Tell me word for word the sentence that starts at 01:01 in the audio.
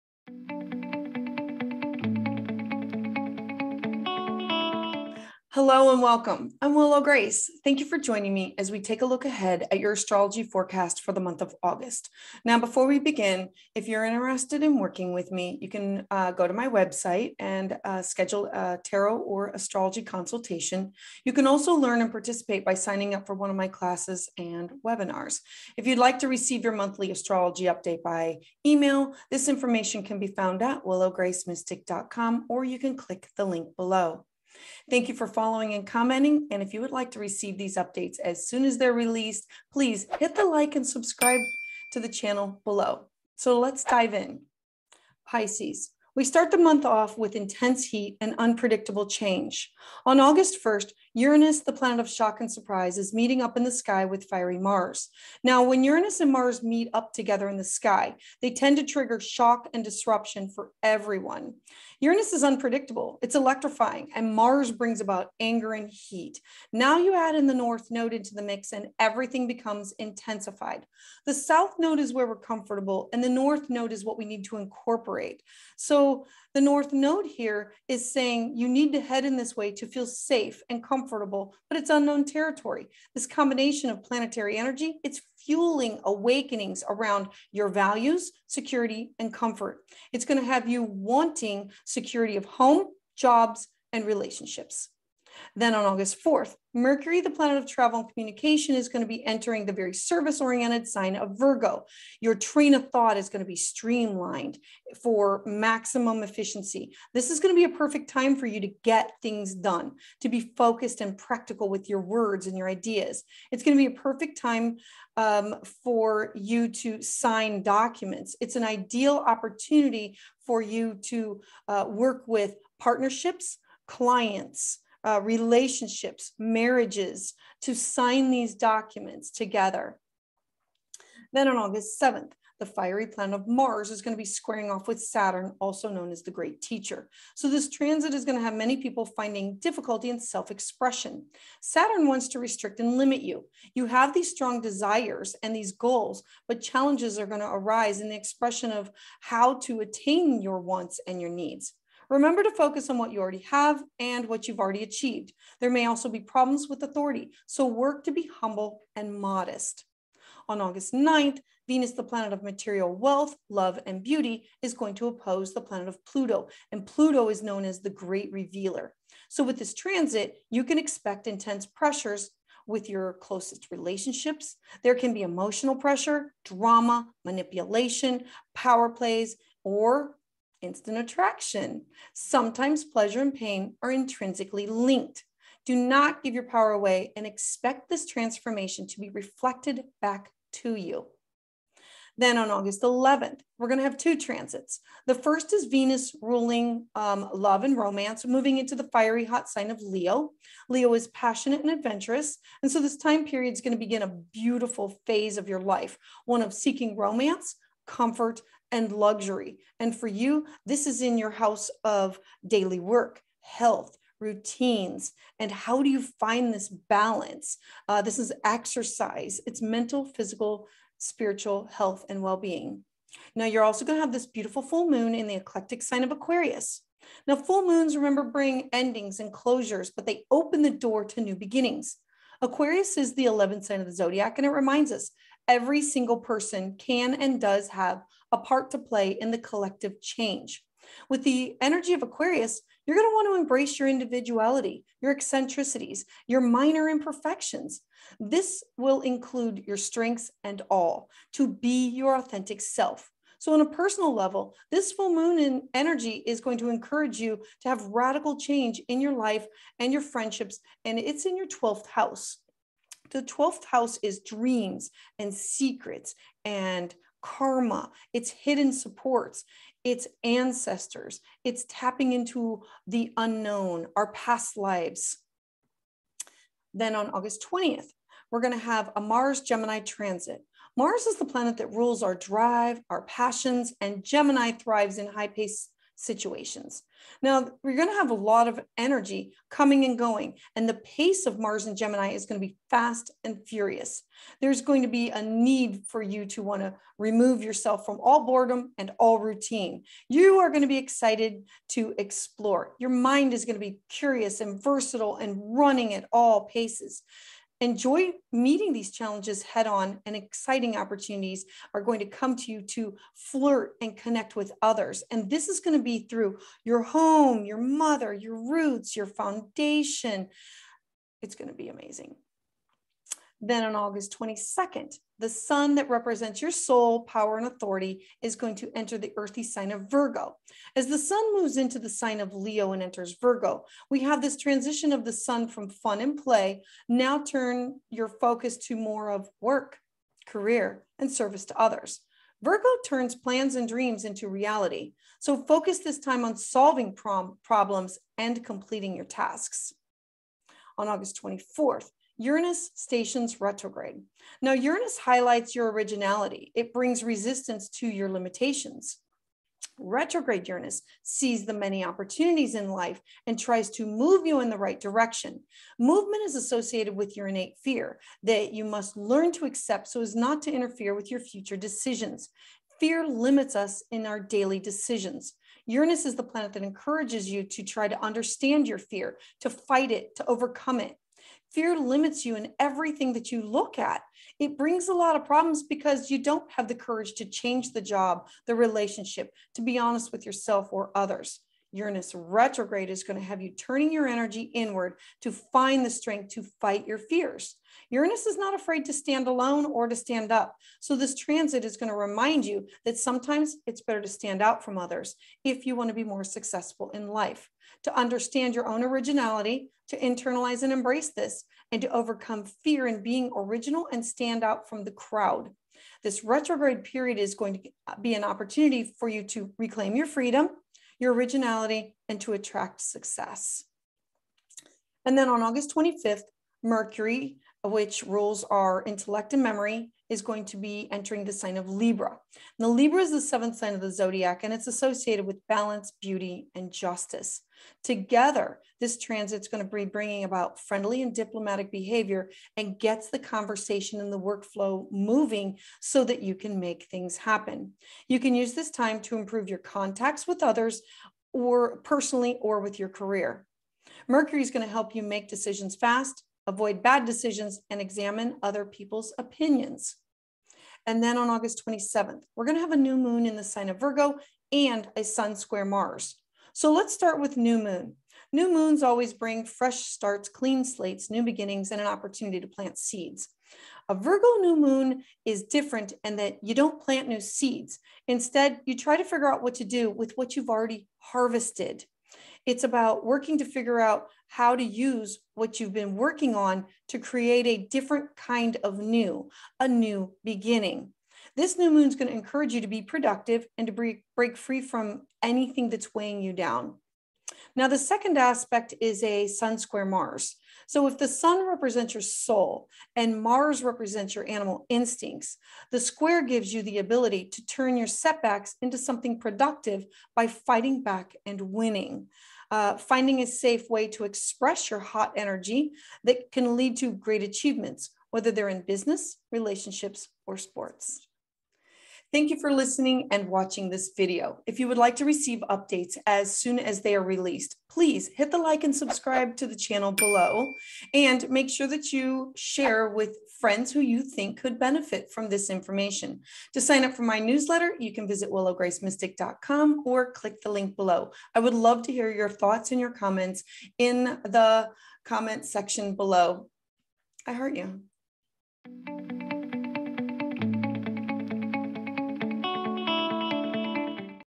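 Uranus is unpredictable, it's electrifying, and Mars brings about anger and heat.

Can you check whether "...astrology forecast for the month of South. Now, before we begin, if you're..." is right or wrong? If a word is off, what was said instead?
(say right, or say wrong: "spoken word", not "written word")
wrong: "August", not "South".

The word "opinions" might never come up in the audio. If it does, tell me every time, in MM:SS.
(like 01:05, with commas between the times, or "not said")
07:39.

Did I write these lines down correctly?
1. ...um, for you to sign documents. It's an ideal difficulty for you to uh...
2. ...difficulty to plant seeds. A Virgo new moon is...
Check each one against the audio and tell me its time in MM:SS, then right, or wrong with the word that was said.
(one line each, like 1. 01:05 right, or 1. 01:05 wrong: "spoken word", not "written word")
1. 01:55 wrong: "opportunity", not "difficulty"
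2. 07:51 wrong: "opportunity", not "difficulty".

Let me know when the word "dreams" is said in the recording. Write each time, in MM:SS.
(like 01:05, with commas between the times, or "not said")
04:24, 05:43.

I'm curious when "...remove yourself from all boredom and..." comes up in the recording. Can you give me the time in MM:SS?
04:56.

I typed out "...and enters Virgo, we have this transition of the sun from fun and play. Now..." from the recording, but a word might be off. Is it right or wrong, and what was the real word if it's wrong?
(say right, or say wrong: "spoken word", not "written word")
right.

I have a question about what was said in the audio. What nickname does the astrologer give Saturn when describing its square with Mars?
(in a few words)
The Great Teacher.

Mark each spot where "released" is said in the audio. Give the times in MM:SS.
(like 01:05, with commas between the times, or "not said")
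00:38, 08:47.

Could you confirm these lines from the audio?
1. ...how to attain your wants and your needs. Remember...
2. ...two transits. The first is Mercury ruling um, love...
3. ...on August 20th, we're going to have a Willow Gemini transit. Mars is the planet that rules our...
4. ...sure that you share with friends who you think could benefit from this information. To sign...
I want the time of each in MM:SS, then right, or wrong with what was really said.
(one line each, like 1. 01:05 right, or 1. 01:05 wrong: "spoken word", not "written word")
1. 02:29 right
2. 03:13 wrong: "Venus", not "Mercury"
3. 04:36 wrong: "Mars", not "Willow"
4. 08:51 right.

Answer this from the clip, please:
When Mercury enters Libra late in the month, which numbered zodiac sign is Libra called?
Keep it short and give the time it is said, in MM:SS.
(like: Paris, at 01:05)
7th, at 07:13.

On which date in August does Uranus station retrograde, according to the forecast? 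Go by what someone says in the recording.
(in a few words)
August 24th.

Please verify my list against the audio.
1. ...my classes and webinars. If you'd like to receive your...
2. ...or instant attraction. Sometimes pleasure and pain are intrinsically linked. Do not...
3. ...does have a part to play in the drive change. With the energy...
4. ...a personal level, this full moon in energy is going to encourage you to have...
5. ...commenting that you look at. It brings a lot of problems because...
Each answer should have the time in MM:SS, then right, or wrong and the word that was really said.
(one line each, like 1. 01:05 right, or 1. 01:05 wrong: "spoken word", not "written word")
1. 00:23 right
2. 02:59 right
3. 03:57 wrong: "collective", not "drive"
4. 04:13 right
5. 06:22 wrong: "everything", not "commenting".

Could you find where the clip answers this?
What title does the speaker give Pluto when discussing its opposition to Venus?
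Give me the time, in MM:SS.
02:47.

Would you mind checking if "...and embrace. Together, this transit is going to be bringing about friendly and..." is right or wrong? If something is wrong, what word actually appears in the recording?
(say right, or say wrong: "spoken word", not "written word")
wrong: "justice", not "embrace".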